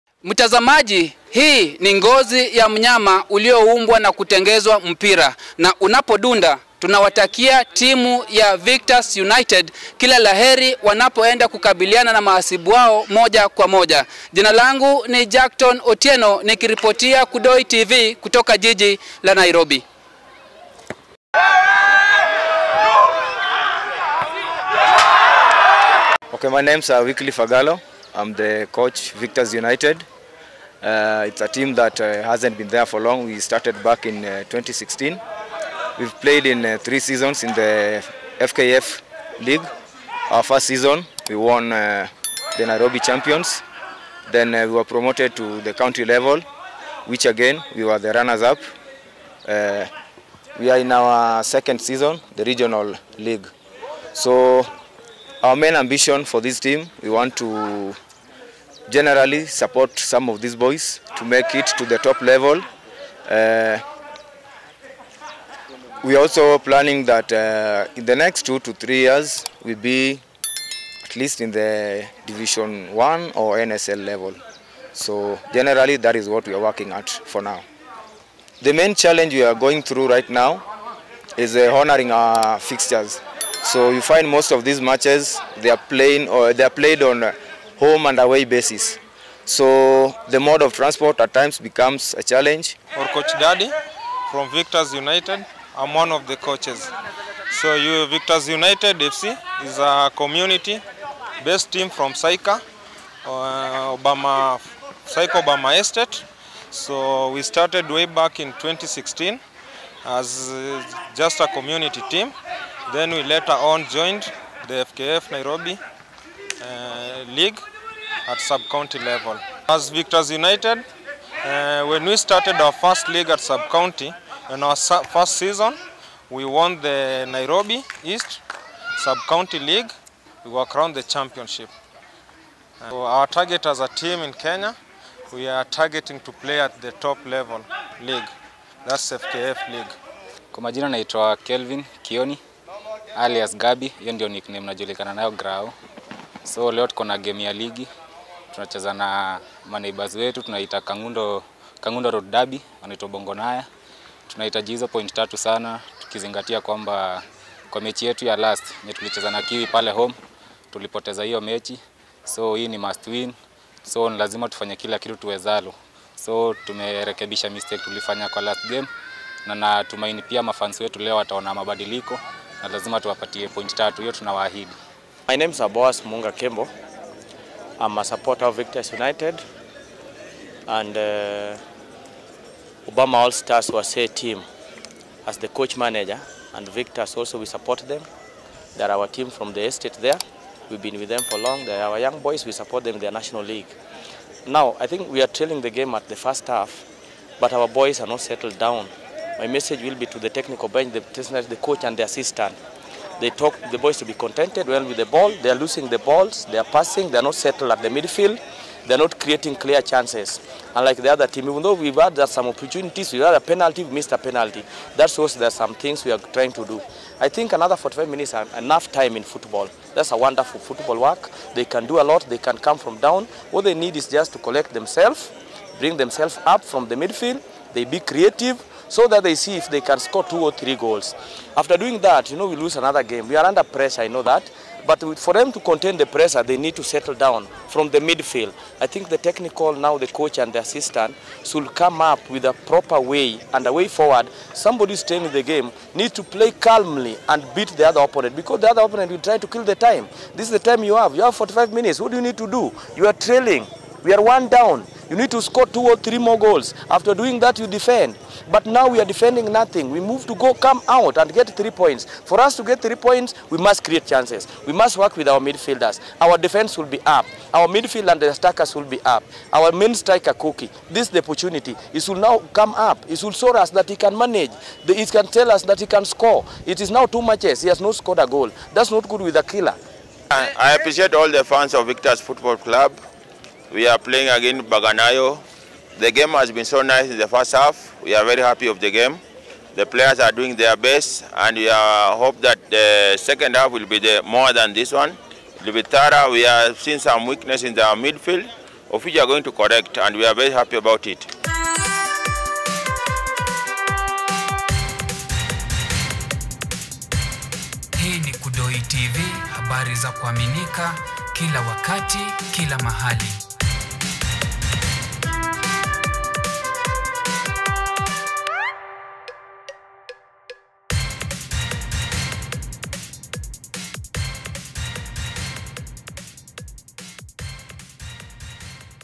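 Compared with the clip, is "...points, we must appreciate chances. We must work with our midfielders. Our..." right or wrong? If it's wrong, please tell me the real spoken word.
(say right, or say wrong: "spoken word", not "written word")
wrong: "create", not "appreciate".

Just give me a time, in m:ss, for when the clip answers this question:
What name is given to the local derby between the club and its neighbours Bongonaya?
2:31.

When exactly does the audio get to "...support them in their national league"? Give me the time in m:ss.
3:12.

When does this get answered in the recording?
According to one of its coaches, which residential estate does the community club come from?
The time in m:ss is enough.
1:45.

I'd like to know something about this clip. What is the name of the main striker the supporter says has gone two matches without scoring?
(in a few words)
Cookie.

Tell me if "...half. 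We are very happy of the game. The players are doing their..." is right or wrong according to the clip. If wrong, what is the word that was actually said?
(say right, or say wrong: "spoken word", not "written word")
right.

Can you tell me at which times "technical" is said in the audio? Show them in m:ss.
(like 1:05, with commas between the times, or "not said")
3:20, 3:59.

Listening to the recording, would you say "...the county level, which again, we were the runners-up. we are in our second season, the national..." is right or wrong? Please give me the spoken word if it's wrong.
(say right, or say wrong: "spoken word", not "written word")
wrong: "regional", not "national".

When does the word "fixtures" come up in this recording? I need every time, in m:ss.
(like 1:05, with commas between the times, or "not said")
1:22.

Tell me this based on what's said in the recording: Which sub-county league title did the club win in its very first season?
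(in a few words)
Nairobi East Sub-County League.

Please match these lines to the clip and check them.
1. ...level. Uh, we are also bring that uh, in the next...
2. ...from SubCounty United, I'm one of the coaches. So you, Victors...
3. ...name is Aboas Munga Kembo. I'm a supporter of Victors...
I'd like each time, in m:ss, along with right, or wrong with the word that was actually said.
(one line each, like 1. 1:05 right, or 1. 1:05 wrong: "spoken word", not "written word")
1. 1:02 wrong: "planning", not "bring"
2. 1:34 wrong: "Victors", not "SubCounty"
3. 2:55 right.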